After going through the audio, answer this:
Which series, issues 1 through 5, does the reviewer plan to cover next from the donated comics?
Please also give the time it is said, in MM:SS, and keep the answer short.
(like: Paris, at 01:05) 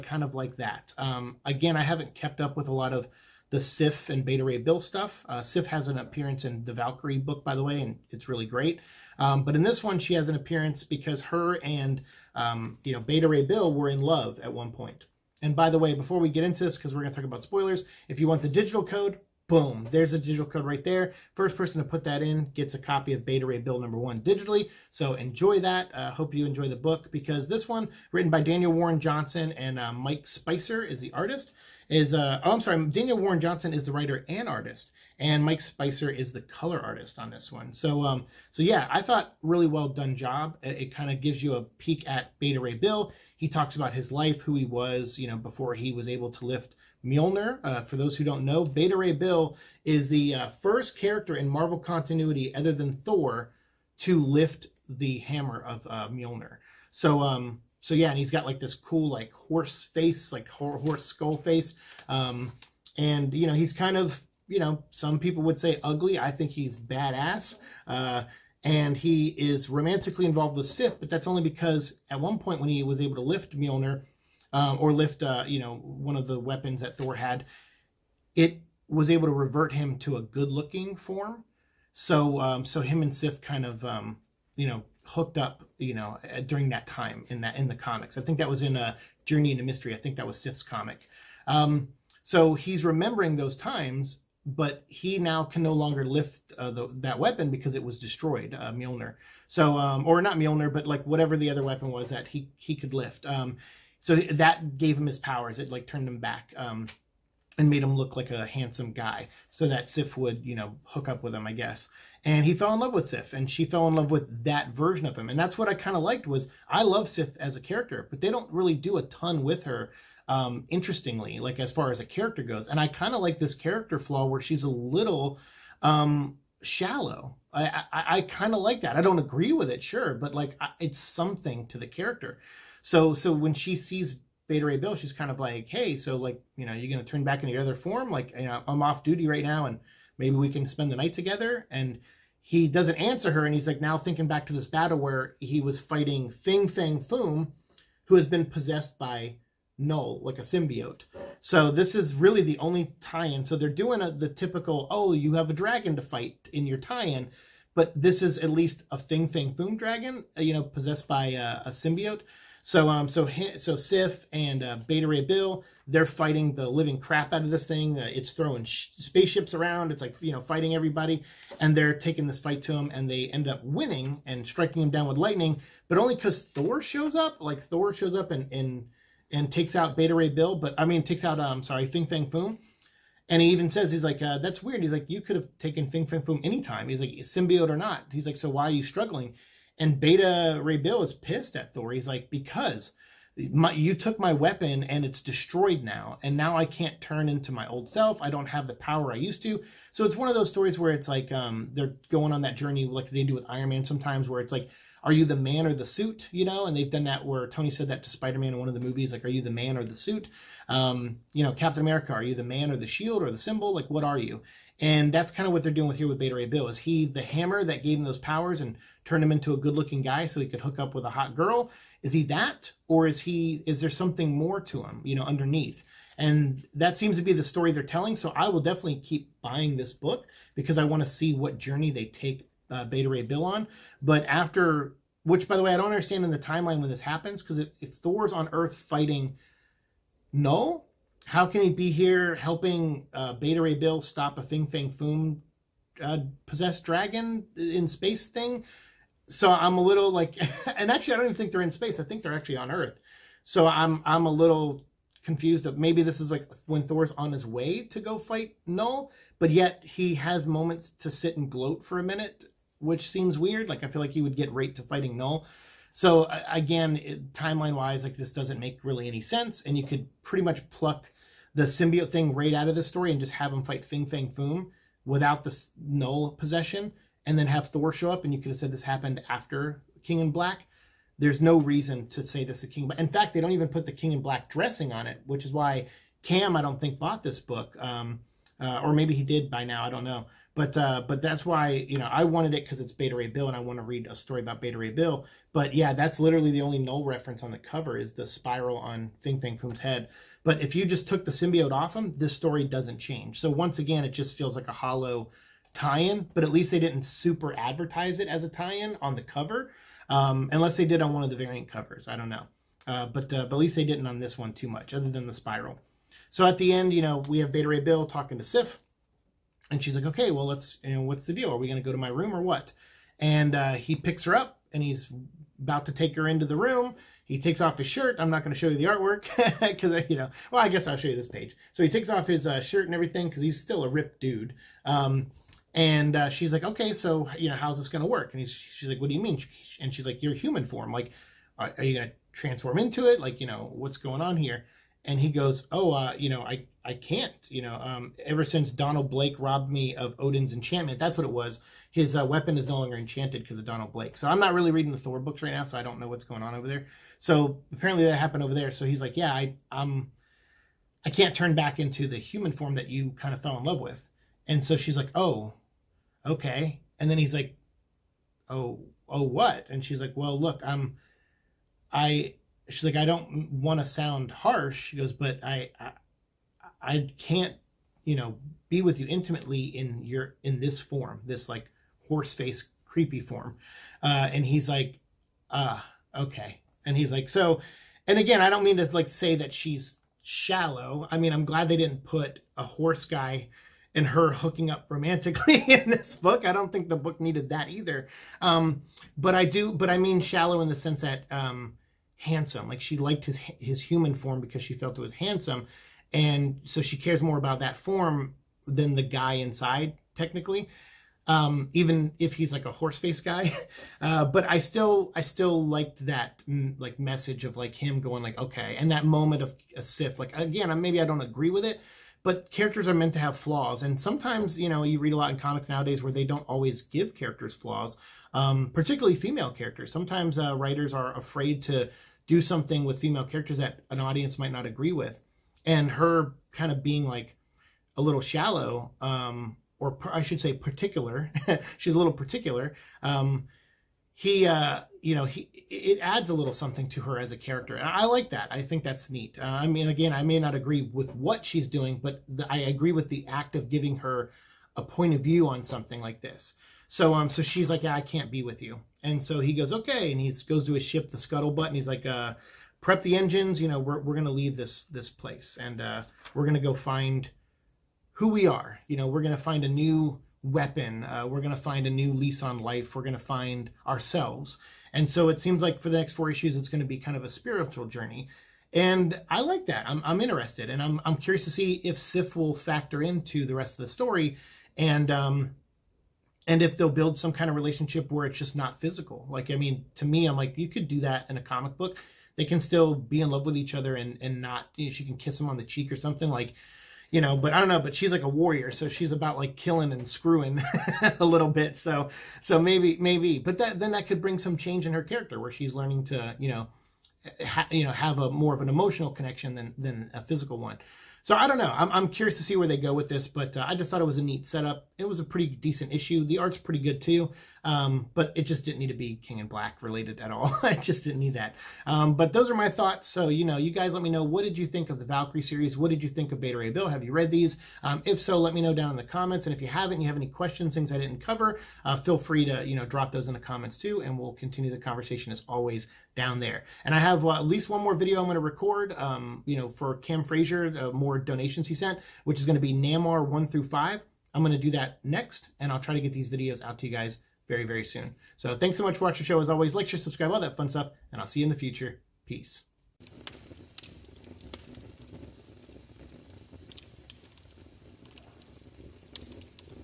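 Namor, at 09:02.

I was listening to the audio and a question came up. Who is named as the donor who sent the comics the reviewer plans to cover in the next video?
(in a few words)
Cam Frazier.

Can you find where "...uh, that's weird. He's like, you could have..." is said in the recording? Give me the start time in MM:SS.
03:04.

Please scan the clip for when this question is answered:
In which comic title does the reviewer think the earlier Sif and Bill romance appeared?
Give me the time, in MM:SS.
01:29.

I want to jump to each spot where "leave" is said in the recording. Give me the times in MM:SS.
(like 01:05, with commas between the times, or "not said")
07:44.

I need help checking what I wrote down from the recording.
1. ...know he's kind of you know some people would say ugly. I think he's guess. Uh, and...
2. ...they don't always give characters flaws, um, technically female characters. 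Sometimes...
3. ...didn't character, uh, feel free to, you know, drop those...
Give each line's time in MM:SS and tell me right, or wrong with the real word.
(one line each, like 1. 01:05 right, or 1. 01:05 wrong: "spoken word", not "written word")
1. 01:03 wrong: "badass", not "guess"
2. 07:06 wrong: "particularly", not "technically"
3. 08:50 wrong: "cover", not "character".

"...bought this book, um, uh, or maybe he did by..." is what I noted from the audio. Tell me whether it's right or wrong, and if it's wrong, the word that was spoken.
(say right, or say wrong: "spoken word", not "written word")
right.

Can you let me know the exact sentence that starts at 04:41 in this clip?
There's no reason to say this is King.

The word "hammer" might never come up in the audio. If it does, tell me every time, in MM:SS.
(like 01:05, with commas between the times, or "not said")
00:55, 03:37.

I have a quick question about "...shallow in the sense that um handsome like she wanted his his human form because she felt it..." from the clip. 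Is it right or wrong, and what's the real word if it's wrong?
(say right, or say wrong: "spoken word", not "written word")
wrong: "liked", not "wanted".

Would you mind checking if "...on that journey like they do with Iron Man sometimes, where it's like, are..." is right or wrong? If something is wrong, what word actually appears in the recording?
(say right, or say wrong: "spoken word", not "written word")
right.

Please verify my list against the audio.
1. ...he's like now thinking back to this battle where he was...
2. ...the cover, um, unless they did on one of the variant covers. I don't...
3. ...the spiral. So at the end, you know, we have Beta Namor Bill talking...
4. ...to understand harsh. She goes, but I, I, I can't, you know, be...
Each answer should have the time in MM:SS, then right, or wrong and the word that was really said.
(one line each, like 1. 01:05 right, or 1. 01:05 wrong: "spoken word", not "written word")
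1. 02:23 right
2. 05:09 right
3. 05:15 wrong: "Ray", not "Namor"
4. 06:13 wrong: "sound", not "understand".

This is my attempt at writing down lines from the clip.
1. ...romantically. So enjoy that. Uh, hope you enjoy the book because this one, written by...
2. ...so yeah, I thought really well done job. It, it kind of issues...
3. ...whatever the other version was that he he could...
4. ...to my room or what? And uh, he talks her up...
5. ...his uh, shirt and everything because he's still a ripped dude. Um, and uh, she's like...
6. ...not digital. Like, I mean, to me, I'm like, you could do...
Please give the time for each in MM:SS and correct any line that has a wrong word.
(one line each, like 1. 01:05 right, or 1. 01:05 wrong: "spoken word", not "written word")
1. 00:24 wrong: "digitally", not "romantically"
2. 00:38 wrong: "gives", not "issues"
3. 01:41 wrong: "weapon", not "version"
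4. 05:21 wrong: "picks", not "talks"
5. 05:32 right
6. 08:08 wrong: "physical", not "digital".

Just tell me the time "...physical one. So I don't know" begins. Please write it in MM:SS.
08:30.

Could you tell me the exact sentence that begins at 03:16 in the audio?
And now I can't turn into my old self.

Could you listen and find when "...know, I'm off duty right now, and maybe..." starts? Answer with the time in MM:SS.
02:18.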